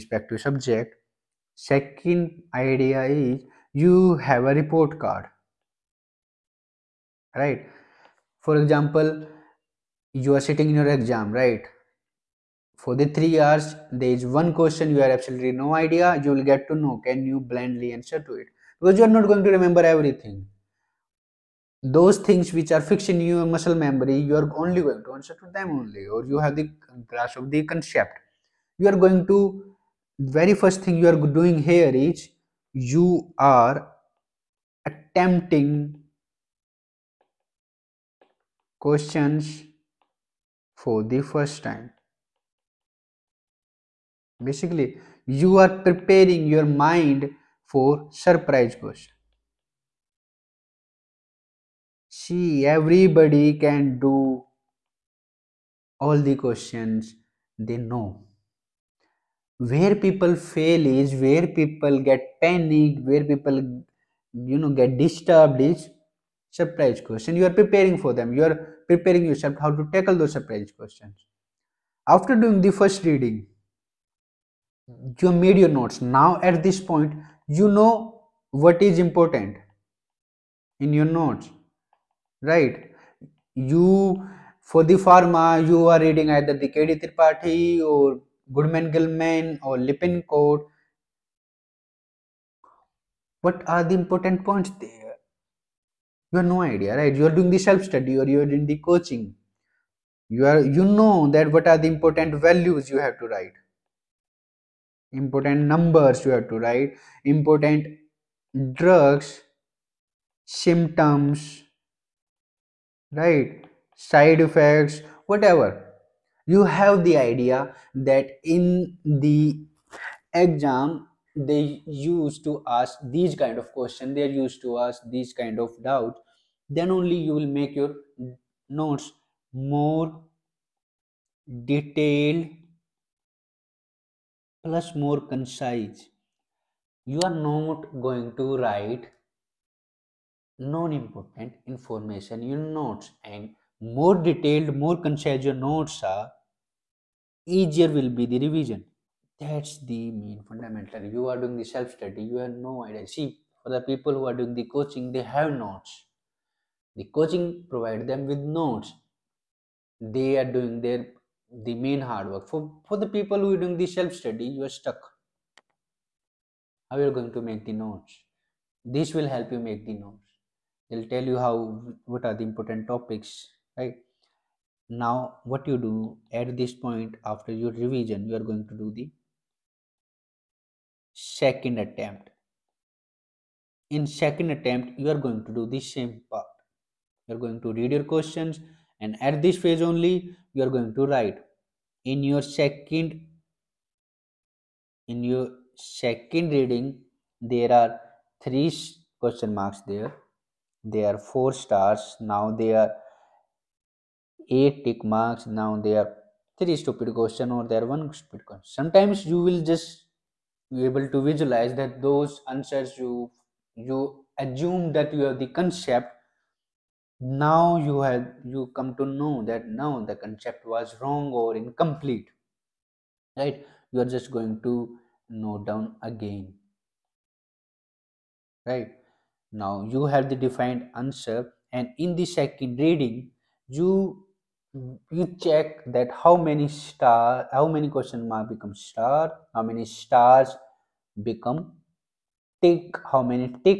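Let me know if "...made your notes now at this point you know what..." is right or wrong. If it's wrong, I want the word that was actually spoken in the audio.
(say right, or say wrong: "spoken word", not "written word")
right.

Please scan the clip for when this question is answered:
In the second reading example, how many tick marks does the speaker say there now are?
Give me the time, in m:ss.
3:24.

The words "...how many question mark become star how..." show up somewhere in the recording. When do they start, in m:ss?
3:57.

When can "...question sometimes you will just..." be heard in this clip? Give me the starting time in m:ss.
3:28.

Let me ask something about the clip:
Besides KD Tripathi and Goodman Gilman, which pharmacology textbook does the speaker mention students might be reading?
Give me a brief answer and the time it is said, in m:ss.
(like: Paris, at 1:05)
Lippincott, at 1:29.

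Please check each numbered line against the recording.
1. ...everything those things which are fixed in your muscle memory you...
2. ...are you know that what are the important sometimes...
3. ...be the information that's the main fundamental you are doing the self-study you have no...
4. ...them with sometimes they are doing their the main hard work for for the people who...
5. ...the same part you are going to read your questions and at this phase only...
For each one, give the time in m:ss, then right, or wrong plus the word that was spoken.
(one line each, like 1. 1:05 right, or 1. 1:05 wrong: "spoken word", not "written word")
1. 0:19 right
2. 1:40 wrong: "values", not "sometimes"
3. 2:28 wrong: "revision", not "information"
4. 2:38 wrong: "notes", not "sometimes"
5. 3:05 right.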